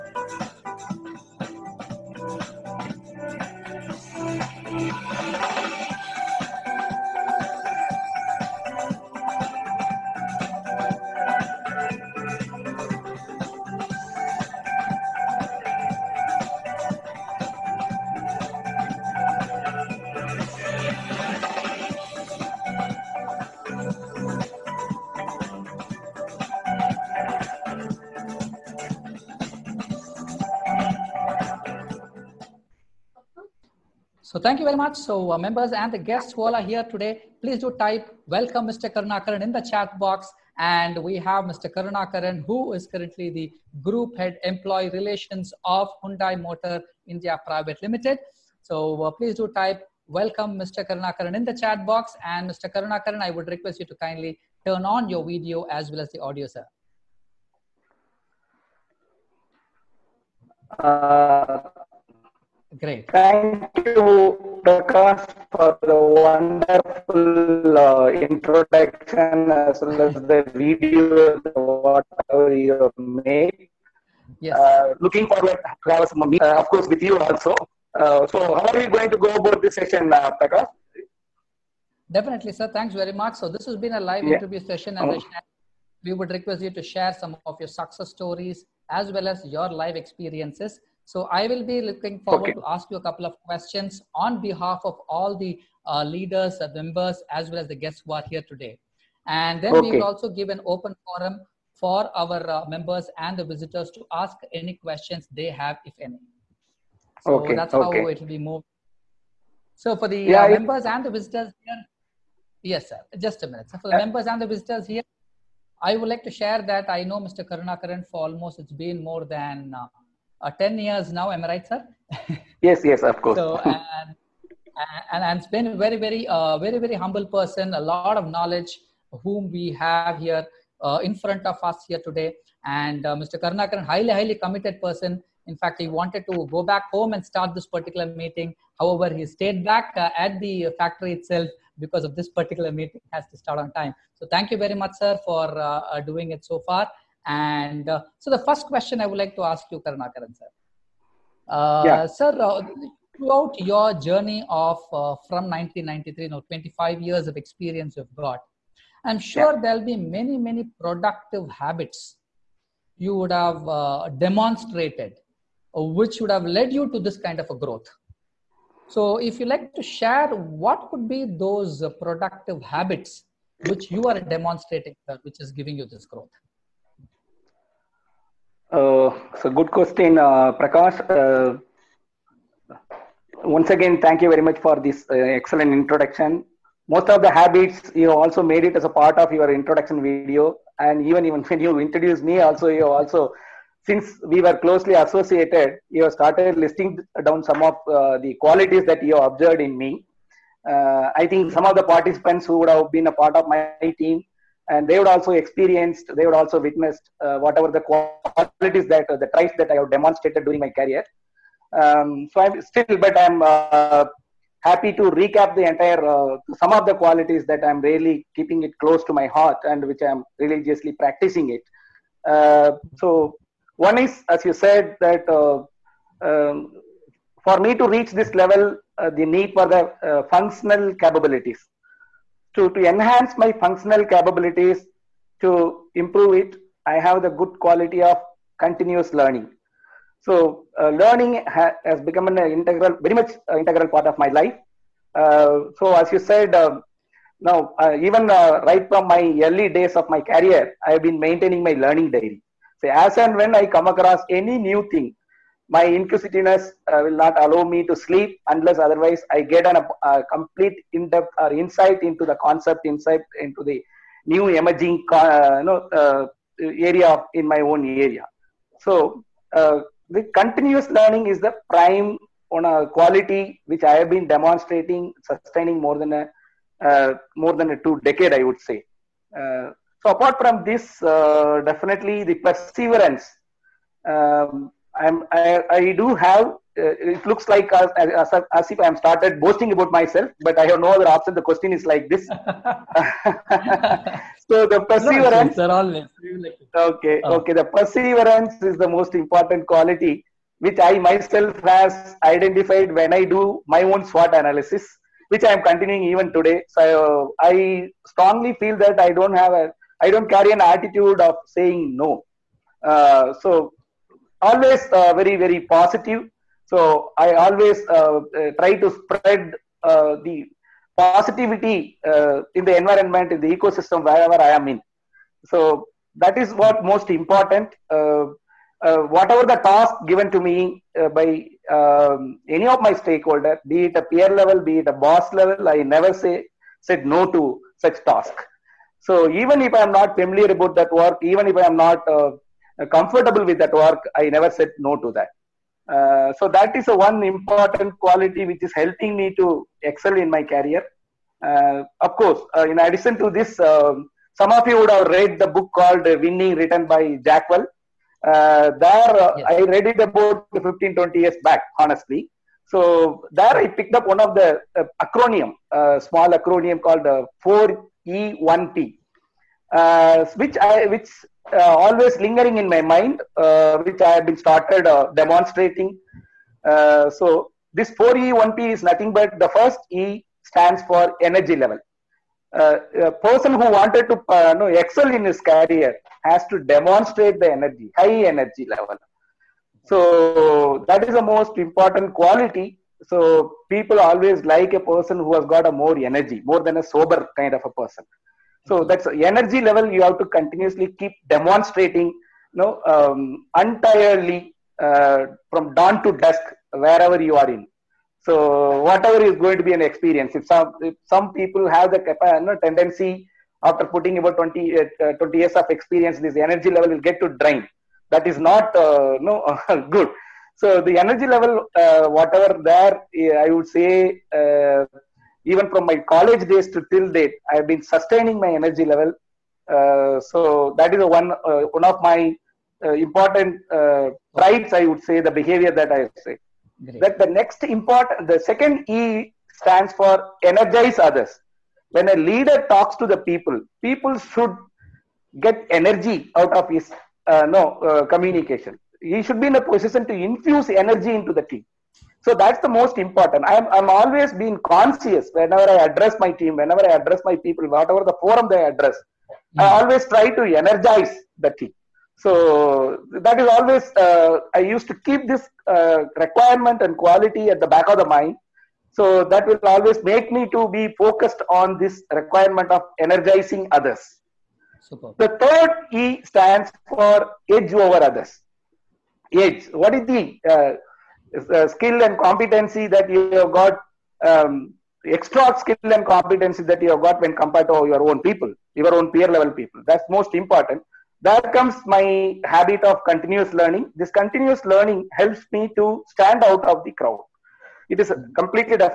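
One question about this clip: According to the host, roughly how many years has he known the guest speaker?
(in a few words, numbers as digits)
more than 10 years.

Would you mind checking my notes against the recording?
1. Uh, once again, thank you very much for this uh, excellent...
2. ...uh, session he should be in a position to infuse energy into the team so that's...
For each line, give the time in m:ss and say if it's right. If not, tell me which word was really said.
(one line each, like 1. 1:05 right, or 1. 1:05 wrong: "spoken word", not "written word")
1. 3:01 right
2. 7:27 wrong: "communication", not "session".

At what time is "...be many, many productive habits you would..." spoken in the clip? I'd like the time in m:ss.
2:39.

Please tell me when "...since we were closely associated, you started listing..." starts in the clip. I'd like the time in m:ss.
3:13.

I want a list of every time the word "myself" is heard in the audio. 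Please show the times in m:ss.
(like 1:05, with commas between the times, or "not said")
4:49, 5:00.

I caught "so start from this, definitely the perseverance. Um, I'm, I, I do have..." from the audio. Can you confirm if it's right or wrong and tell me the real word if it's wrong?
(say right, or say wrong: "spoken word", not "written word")
wrong: "apart", not "start".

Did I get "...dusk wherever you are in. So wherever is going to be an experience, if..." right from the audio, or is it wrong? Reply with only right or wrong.
wrong.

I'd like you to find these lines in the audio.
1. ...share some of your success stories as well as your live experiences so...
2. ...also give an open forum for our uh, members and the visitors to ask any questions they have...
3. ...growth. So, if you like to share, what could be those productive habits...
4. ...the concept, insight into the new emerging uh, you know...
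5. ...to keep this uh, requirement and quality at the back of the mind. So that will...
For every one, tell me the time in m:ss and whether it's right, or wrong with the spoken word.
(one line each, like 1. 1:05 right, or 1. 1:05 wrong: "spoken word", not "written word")
1. 1:26 right
2. 1:40 right
3. 2:47 right
4. 4:22 right
5. 7:44 right.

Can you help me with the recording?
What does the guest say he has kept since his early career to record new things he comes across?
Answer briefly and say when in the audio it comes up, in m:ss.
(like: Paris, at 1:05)
learning diary, at 4:11.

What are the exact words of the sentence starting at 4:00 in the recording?
So uh, learning ha- has become an integral, very much uh, integral part of my life.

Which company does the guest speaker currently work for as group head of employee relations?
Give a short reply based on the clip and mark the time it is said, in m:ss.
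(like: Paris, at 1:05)
Hyundai Motor India, at 0:46.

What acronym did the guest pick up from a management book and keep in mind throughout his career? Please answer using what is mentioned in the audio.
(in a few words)
4E1P.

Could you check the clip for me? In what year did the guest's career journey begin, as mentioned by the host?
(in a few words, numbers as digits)
1993.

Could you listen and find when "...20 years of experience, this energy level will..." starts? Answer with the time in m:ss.
6:55.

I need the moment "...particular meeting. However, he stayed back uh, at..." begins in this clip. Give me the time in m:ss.
2:17.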